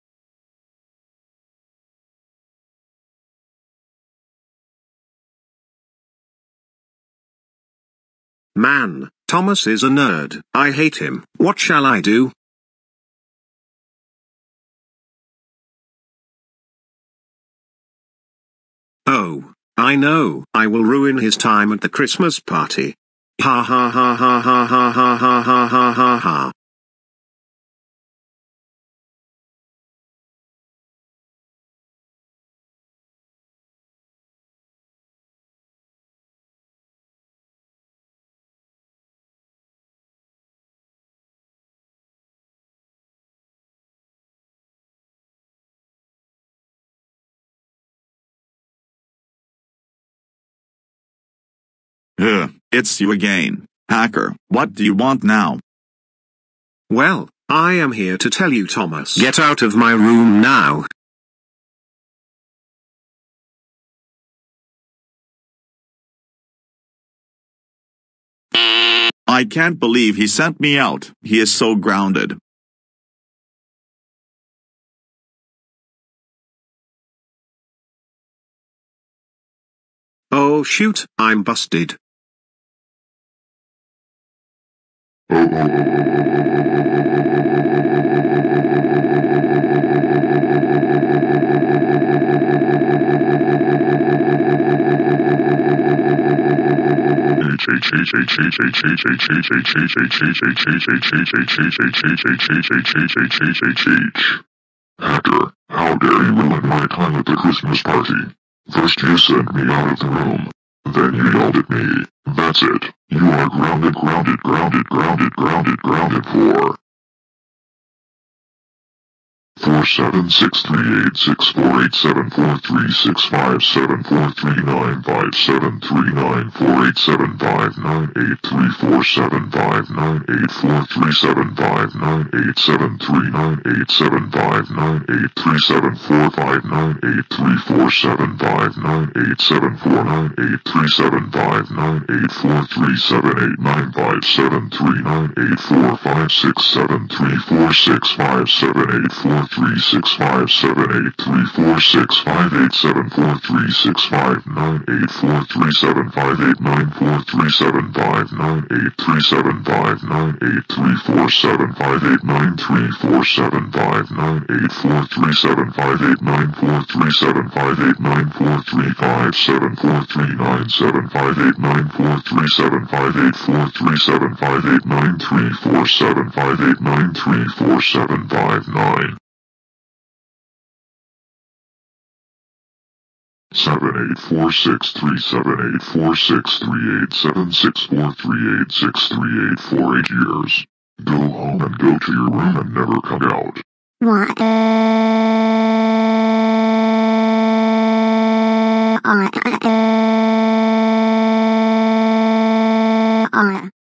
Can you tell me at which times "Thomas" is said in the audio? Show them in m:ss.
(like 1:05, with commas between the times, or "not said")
0:09, 0:58.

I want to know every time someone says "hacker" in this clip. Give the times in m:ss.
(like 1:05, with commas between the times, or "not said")
0:53, 1:25.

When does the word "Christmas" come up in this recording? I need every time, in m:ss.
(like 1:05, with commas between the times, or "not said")
0:21, 1:47.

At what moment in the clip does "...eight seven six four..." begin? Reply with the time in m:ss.
3:07.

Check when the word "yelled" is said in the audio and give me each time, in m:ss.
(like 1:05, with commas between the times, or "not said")
1:51.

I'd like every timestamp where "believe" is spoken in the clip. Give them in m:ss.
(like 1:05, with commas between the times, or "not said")
1:09.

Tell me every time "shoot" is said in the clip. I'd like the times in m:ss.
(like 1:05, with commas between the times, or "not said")
1:20.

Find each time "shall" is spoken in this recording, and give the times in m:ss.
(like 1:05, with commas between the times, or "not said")
0:11.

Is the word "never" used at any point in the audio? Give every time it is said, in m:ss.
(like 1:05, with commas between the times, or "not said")
3:12.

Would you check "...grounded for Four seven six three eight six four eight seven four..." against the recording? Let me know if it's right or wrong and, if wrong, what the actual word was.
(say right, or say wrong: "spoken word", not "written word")
right.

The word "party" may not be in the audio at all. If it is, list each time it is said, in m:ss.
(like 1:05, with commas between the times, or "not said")
0:22, 1:47.